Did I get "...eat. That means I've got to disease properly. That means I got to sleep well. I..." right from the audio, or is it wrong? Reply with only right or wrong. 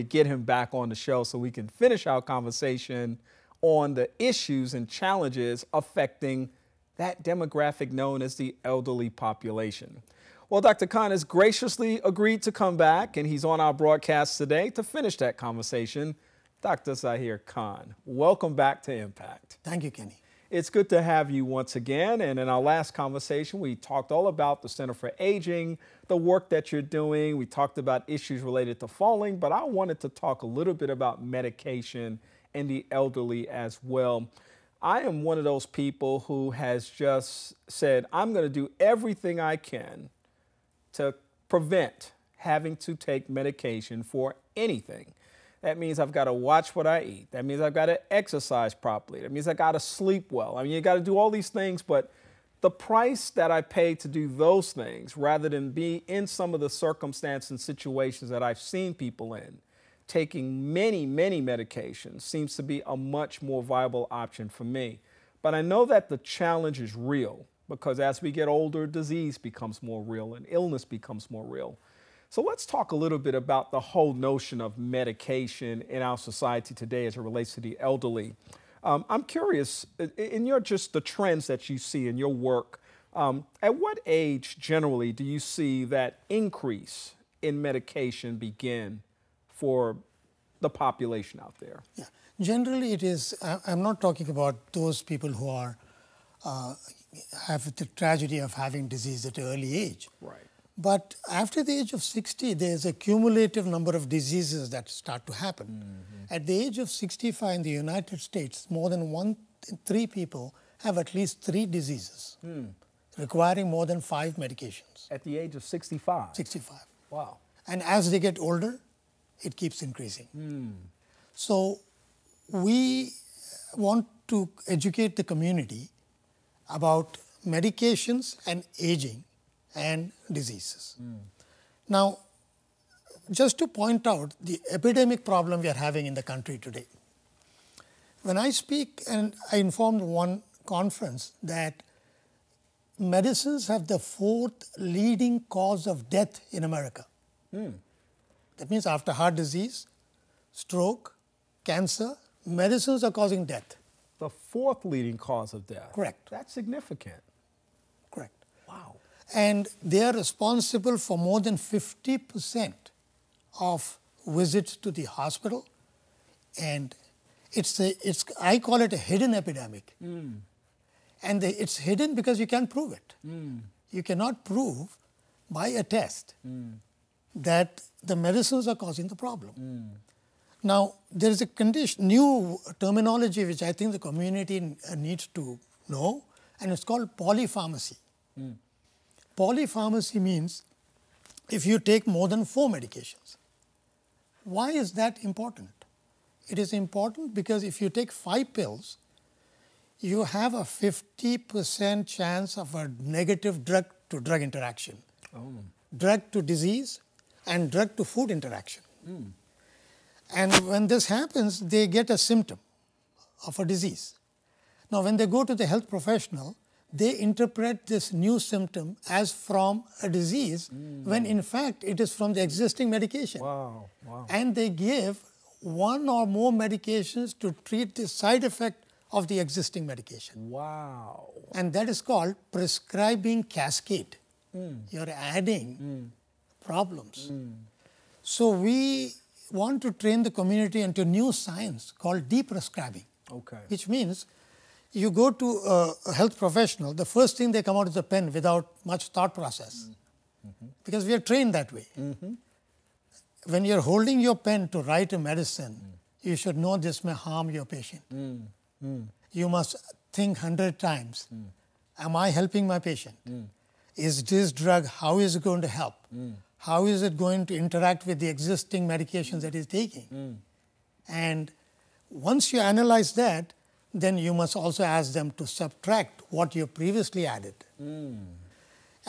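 wrong.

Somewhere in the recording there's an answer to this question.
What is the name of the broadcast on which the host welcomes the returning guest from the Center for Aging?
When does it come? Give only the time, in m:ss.
0:18.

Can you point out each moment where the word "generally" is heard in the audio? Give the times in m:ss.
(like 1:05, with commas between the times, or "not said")
1:24, 1:32.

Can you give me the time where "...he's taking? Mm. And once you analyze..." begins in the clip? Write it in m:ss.
4:29.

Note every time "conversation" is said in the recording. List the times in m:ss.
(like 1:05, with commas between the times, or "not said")
0:02, 0:15, 0:22.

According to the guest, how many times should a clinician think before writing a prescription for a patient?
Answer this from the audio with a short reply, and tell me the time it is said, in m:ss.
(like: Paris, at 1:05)
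100 times, at 4:20.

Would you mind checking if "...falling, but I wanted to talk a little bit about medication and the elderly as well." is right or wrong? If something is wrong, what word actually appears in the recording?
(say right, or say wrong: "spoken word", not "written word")
right.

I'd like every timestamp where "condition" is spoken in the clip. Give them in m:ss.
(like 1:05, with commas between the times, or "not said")
3:01.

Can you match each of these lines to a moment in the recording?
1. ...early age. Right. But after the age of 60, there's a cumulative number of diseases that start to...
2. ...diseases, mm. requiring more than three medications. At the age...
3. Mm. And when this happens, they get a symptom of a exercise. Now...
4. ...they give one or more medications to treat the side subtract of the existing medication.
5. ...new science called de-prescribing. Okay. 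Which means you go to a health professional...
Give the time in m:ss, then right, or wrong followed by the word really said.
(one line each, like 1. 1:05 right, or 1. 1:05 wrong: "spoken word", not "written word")
1. 1:39 right
2. 1:51 wrong: "five", not "three"
3. 3:29 wrong: "disease", not "exercise"
4. 3:44 wrong: "effect", not "subtract"
5. 4:01 right.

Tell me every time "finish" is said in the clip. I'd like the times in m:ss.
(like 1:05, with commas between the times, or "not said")
0:01, 0:14.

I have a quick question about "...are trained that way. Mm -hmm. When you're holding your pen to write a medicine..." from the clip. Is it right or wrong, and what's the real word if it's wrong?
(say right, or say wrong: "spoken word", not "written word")
right.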